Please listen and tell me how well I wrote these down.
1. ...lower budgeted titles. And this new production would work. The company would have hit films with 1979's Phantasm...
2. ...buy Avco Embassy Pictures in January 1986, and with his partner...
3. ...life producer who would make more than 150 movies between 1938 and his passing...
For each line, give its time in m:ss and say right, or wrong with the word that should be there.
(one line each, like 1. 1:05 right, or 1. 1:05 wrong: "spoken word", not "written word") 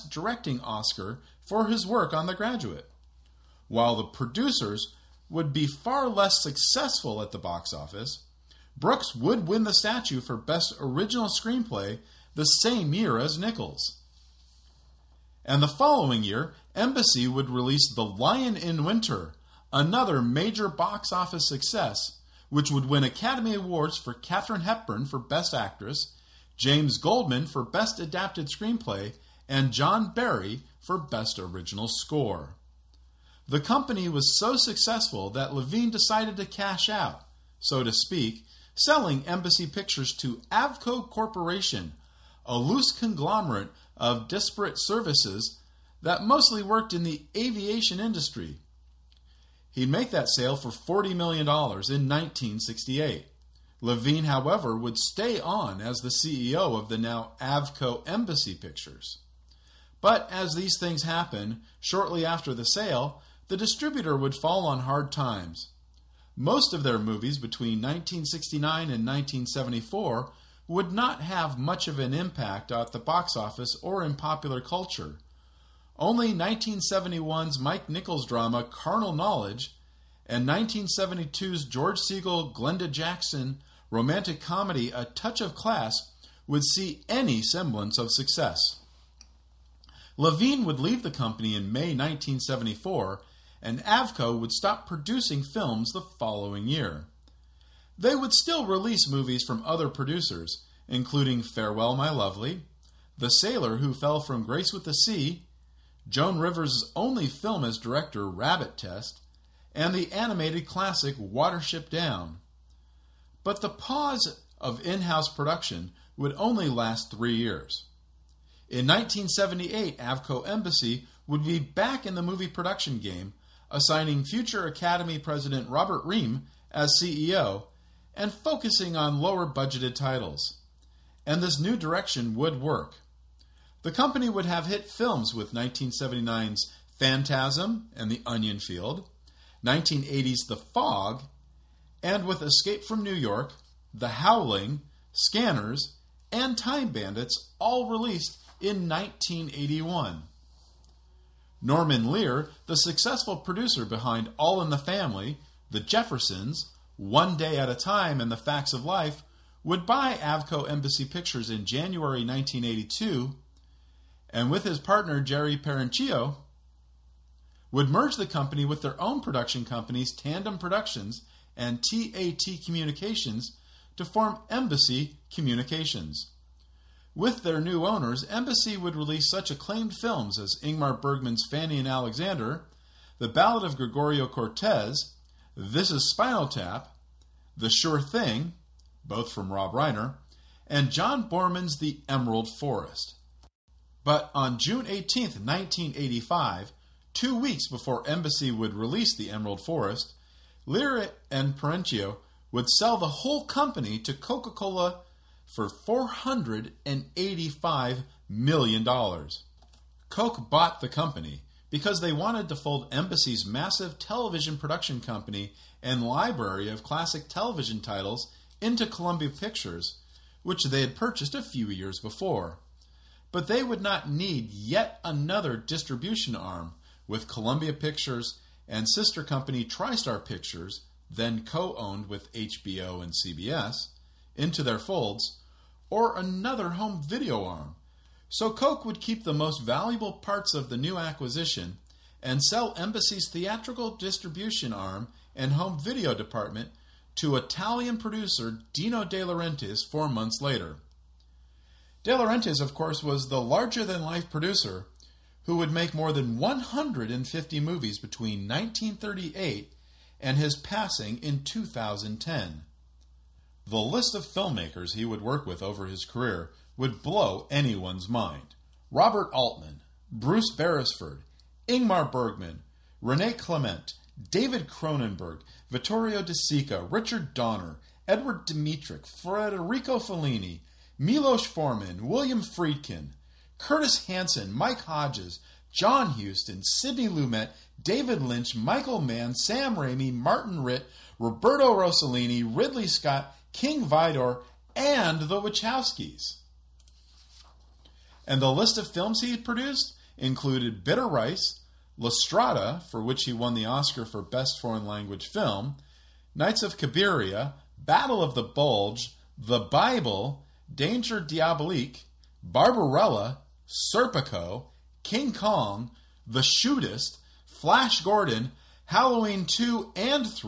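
1. 2:09 wrong: "direction", not "production"
2. 2:39 wrong: "1982", not "1986"
3. 4:14 right.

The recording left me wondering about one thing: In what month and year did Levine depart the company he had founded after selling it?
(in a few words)
May 1974.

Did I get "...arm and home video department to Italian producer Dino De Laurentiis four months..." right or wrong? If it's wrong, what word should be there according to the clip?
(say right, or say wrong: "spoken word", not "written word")
right.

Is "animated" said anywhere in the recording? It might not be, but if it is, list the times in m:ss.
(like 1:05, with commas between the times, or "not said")
1:50.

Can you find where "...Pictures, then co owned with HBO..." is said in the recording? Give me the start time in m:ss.
3:50.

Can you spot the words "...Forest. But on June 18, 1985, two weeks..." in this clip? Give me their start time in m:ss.
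3:12.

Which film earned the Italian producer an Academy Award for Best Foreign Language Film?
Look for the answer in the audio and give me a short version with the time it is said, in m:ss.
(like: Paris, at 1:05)
La Strada, at 5:01.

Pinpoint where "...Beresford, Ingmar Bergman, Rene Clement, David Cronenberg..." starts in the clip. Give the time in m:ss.
4:30.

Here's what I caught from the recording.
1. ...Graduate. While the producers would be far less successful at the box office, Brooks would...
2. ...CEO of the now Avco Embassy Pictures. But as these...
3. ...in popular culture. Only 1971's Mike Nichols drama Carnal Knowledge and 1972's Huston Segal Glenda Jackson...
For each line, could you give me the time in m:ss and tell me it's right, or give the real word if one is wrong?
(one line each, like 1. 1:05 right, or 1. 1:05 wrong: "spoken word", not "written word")
1. 0:02 right
2. 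0:56 right
3. 1:14 wrong: "George", not "Huston".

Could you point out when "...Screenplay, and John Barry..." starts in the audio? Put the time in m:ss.
0:28.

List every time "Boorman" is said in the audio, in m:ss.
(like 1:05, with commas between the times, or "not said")
3:11.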